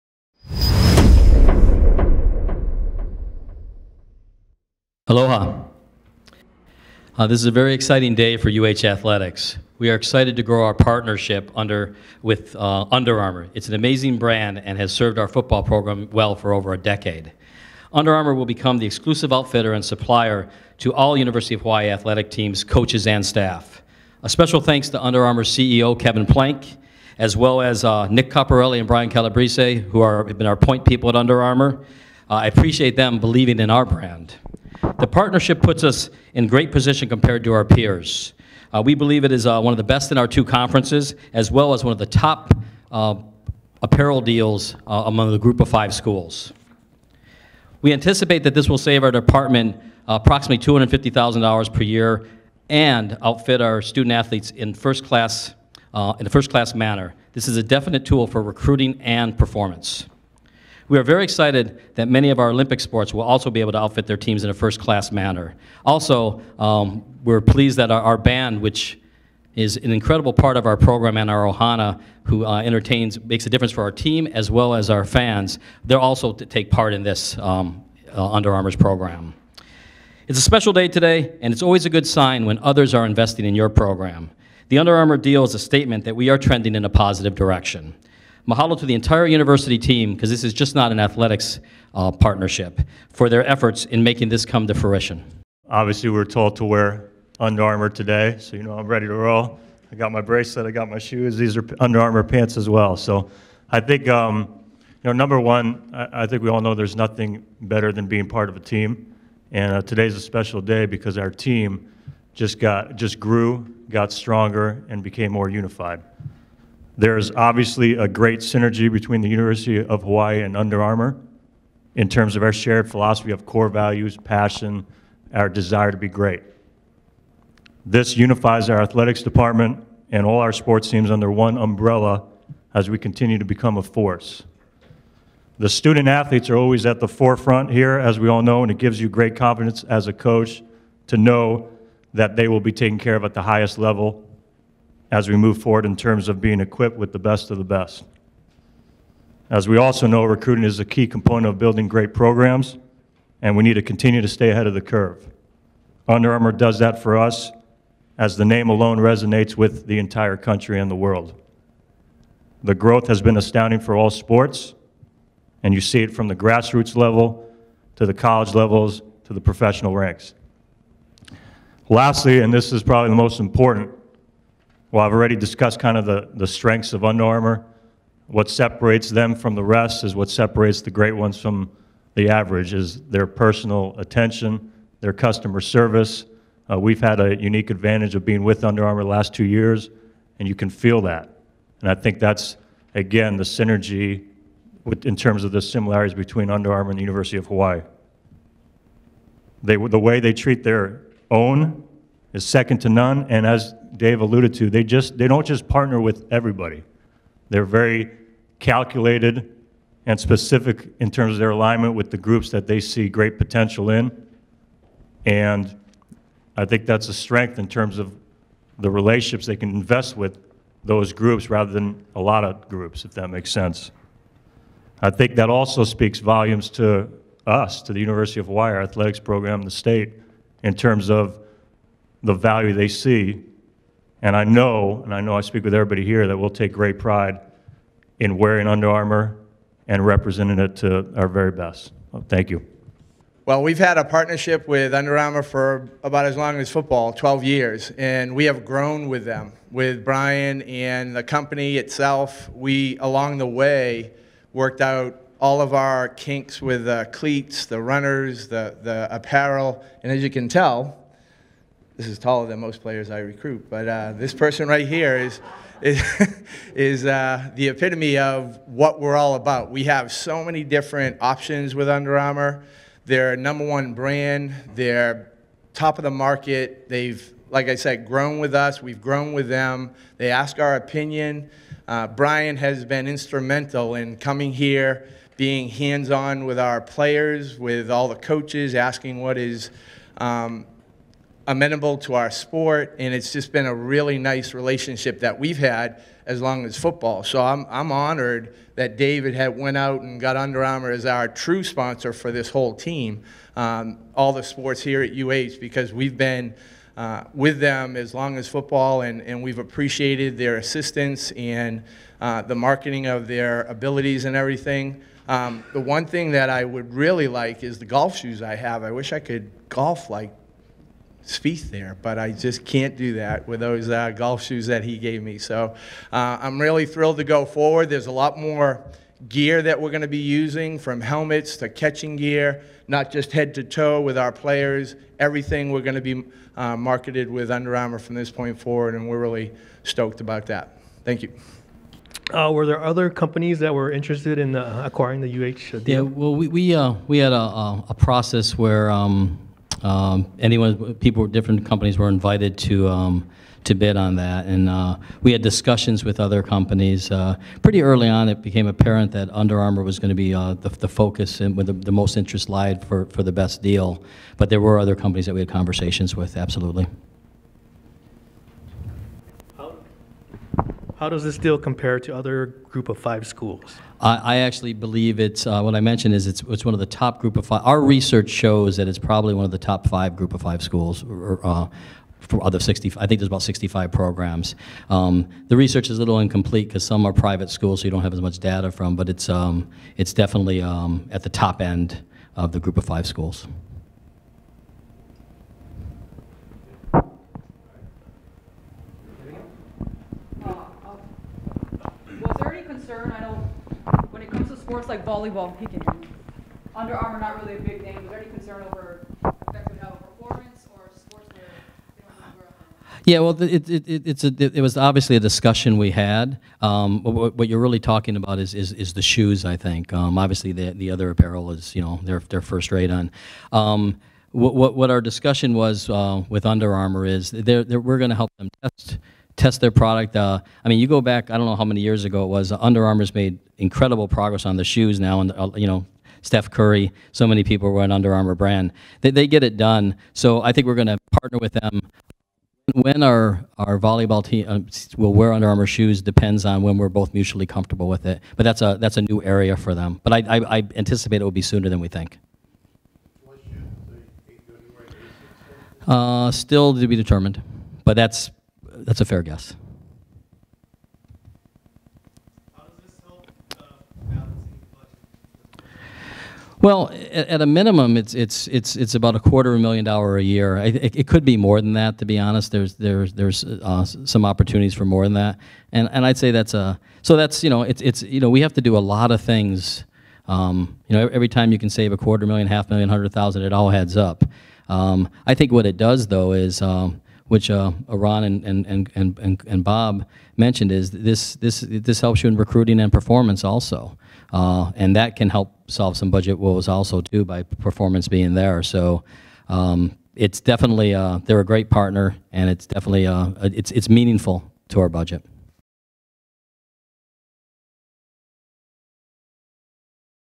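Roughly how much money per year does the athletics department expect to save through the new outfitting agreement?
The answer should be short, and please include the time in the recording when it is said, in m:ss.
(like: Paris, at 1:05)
$250,000, at 0:50.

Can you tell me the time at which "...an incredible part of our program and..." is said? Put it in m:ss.
1:09.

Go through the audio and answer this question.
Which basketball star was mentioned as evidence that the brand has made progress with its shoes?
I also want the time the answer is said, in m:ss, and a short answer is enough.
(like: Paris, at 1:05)
Steph Curry, at 7:16.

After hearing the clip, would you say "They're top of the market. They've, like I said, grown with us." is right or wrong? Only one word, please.
right.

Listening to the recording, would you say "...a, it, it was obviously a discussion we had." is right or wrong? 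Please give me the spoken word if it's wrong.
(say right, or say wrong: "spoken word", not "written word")
right.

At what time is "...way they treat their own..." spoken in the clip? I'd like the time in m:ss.
3:19.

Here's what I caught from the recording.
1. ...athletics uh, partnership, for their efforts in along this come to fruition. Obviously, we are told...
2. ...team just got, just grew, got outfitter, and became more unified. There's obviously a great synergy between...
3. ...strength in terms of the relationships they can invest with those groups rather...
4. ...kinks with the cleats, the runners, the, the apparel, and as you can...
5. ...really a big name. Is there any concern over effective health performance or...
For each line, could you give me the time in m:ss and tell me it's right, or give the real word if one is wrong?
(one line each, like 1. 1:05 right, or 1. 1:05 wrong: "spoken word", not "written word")
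1. 1:30 wrong: "making", not "along"
2. 1:51 wrong: "stronger", not "outfitter"
3. 3:37 right
4. 4:16 right
5. 6:47 right.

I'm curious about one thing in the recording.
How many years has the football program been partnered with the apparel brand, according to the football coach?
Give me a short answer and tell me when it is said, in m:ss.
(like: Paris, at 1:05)
12 years, at 4:07.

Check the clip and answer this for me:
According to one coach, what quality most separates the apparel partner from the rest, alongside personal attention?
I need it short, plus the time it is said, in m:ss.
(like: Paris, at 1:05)
customer service, at 3:05.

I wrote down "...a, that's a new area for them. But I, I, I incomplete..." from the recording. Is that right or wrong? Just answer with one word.
wrong.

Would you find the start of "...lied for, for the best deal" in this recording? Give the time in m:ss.
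6:02.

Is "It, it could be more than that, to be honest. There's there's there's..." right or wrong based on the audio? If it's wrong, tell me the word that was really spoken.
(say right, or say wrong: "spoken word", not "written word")
right.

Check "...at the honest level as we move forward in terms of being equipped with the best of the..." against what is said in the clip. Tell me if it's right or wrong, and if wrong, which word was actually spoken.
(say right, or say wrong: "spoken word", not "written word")
wrong: "highest", not "honest".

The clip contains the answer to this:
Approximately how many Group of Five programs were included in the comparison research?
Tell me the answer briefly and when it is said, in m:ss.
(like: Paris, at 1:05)
65, at 6:23.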